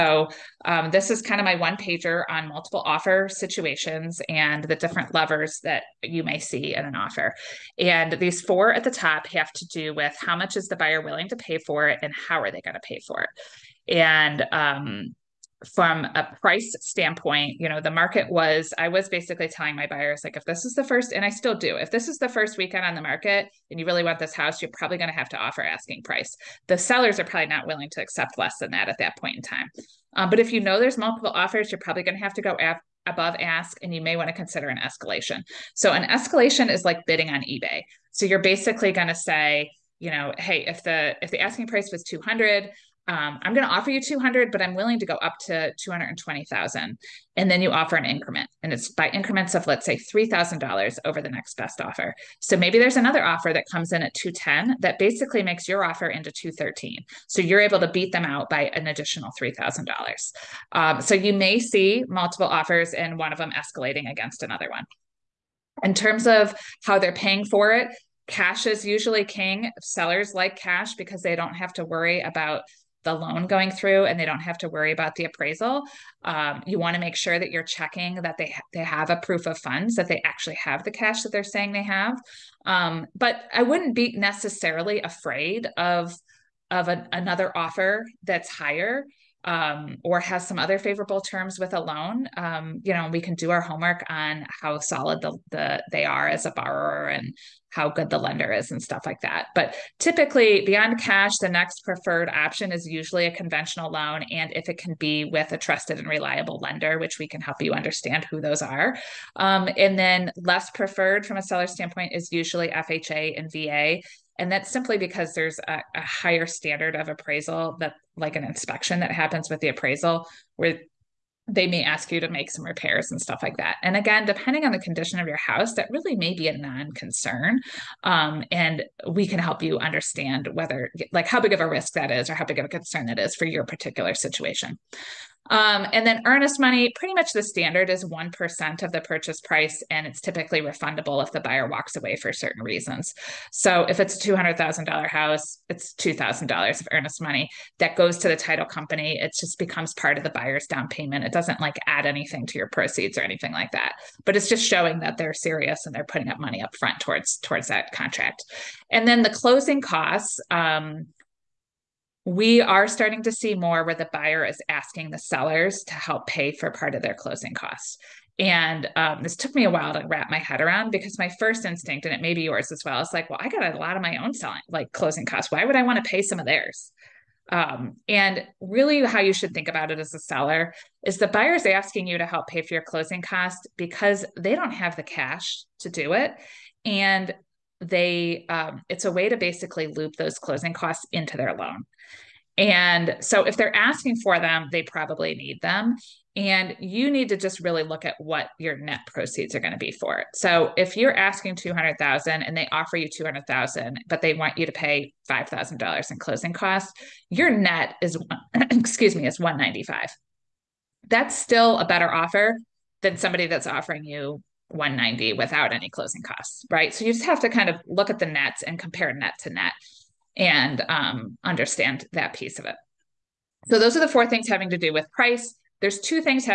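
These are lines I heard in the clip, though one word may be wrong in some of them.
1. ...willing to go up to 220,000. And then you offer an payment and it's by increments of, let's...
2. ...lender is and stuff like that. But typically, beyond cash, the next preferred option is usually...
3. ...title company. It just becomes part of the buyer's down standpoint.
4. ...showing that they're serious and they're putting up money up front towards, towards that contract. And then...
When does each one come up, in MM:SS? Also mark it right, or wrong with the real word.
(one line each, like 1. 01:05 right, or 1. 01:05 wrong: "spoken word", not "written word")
1. 00:44 wrong: "increment", not "payment"
2. 01:38 right
3. 02:28 wrong: "payment", not "standpoint"
4. 02:34 right.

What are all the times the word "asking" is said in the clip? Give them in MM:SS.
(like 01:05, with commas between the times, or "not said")
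00:25, 00:41, 02:44, 03:01, 03:13, 03:21.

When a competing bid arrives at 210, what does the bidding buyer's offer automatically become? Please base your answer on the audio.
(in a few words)
213.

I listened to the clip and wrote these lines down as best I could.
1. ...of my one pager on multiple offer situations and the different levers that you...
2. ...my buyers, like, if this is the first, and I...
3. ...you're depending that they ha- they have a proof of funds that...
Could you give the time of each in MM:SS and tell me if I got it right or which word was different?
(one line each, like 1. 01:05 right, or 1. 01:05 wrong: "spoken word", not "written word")
1. 00:01 right
2. 00:19 right
3. 01:17 wrong: "checking", not "depending".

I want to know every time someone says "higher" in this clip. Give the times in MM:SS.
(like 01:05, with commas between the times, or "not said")
01:28, 01:56.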